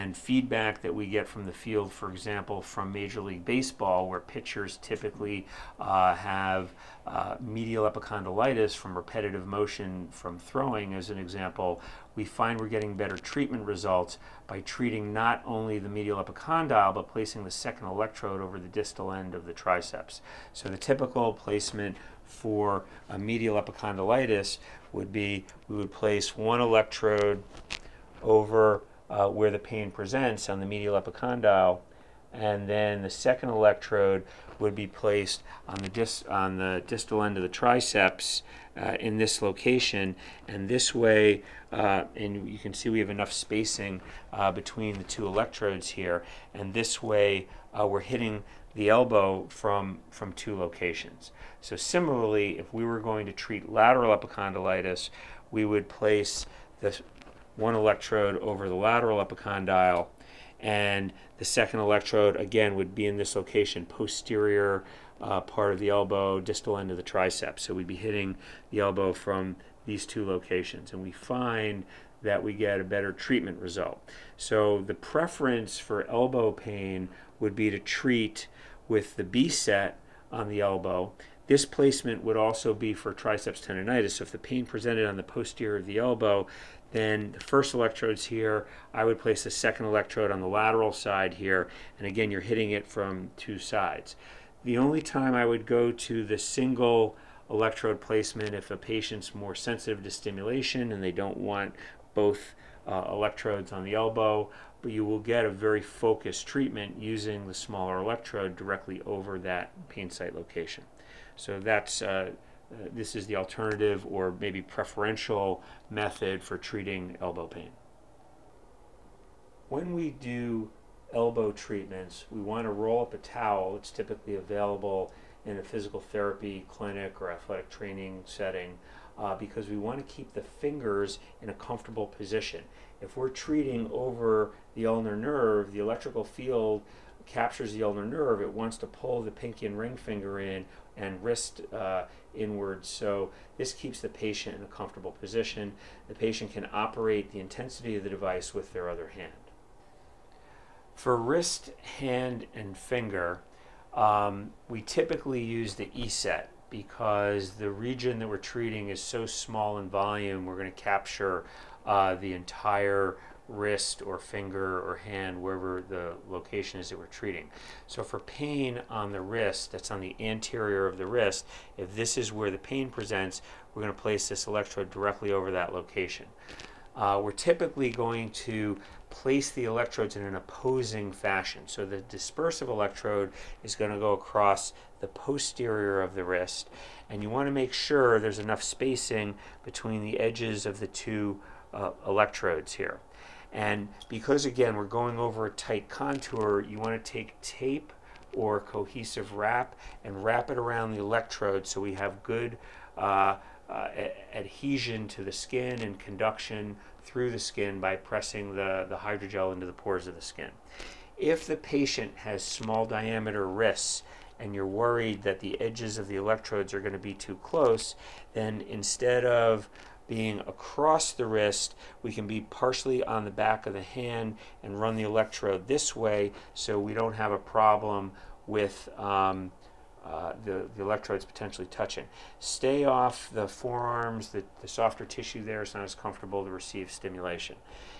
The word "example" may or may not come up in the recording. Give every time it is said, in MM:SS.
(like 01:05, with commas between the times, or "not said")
00:02, 00:11.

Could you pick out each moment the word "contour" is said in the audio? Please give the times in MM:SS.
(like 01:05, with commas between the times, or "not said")
03:15.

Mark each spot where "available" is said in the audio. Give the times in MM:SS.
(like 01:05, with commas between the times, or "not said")
02:04.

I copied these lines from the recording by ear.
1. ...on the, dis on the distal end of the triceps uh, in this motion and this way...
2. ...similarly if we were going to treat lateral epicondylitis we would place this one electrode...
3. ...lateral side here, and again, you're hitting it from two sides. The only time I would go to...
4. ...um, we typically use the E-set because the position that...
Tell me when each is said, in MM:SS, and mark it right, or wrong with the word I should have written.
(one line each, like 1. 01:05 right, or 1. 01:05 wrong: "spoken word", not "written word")
1. 00:35 wrong: "location", not "motion"
2. 00:51 right
3. 01:30 right
4. 02:33 wrong: "region", not "position".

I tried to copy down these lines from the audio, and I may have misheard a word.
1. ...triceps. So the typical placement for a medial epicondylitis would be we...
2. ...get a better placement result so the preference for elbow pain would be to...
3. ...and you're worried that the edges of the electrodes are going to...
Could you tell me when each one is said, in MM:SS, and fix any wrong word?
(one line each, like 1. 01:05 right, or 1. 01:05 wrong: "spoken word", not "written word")
1. 00:19 right
2. 01:12 wrong: "treatment", not "placement"
3. 03:34 right.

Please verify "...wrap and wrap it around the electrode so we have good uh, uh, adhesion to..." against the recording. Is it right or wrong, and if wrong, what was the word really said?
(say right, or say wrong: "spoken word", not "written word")
right.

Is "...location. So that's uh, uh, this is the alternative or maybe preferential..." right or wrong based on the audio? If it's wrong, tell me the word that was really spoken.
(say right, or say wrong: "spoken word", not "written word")
right.